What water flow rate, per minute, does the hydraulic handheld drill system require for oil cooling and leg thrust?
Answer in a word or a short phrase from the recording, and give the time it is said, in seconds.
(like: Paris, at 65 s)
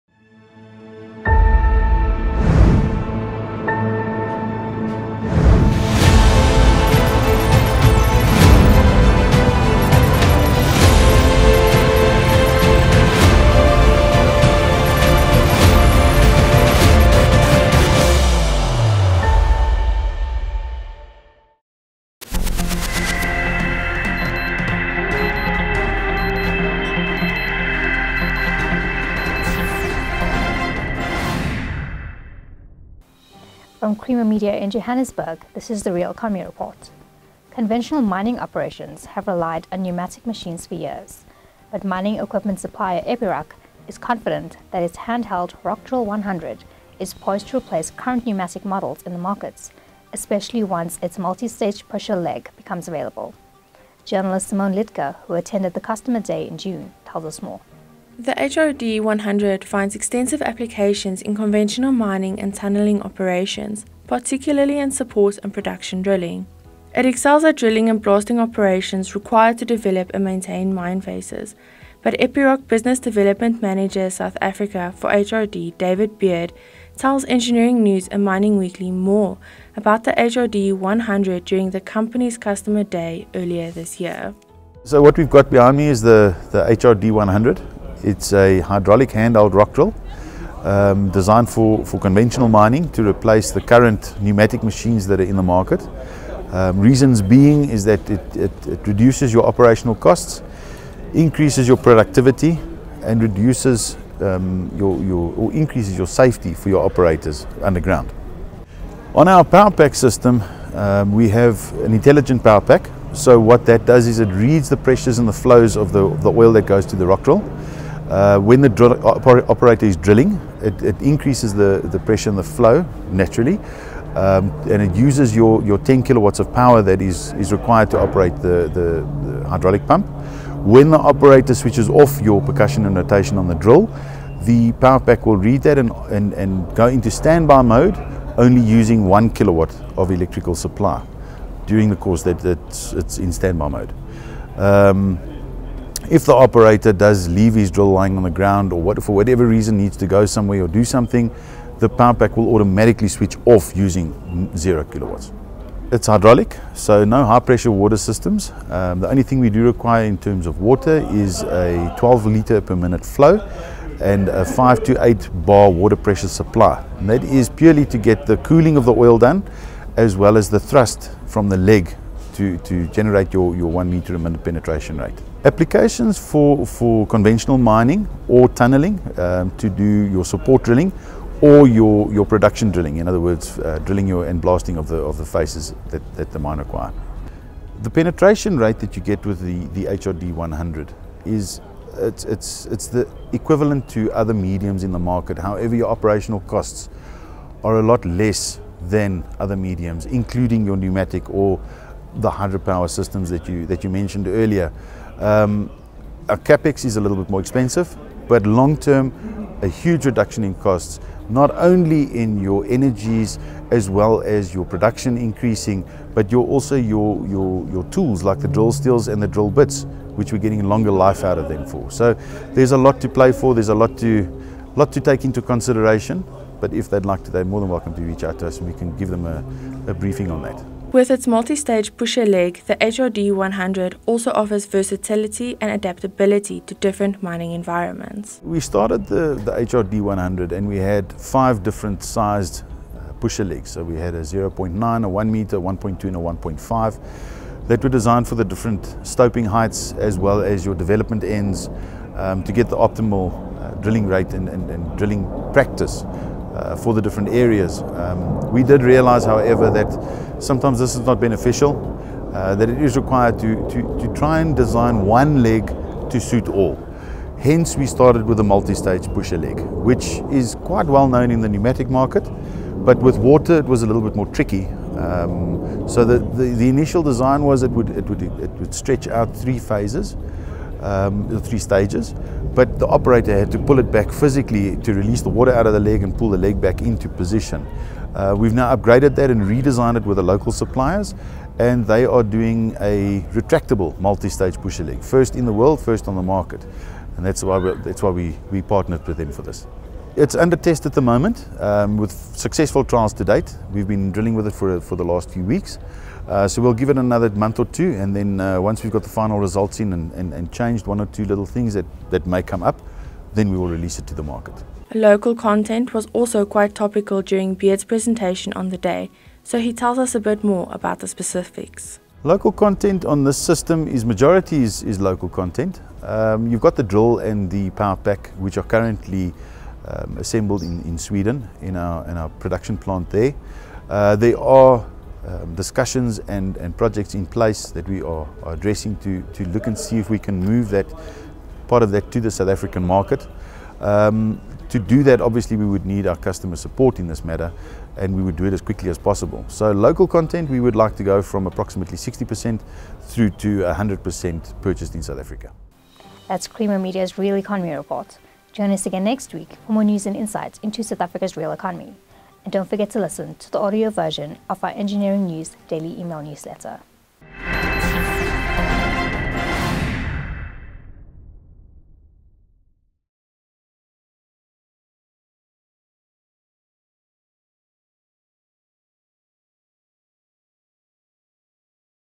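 12 litres per minute, at 161 s.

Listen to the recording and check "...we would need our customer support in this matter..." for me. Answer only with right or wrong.
right.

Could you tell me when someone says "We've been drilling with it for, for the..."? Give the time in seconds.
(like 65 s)
303 s.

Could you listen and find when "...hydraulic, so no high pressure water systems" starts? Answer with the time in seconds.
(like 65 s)
156 s.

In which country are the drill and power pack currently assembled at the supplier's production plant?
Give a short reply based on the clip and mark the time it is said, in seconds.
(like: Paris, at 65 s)
Sweden, at 330 s.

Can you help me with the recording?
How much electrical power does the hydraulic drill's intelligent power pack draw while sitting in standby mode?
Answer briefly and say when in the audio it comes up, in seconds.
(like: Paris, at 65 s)
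1 kilowatt, at 139 s.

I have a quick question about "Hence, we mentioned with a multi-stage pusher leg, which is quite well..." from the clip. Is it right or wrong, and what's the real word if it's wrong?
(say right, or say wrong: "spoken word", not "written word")
wrong: "started", not "mentioned".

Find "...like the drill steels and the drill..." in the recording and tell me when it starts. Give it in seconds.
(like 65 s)
218 s.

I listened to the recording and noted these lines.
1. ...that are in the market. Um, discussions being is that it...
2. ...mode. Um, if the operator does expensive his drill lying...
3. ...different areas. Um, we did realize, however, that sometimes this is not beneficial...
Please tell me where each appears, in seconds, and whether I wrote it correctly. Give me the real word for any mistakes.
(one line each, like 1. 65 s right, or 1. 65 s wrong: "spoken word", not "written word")
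1. 95 s wrong: "reasons", not "discussions"
2. 143 s wrong: "leave", not "expensive"
3. 257 s right.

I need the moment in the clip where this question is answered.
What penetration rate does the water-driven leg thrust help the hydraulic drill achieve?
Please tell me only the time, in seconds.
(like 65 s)
173 s.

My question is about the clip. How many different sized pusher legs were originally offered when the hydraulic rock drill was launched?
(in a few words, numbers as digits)
5.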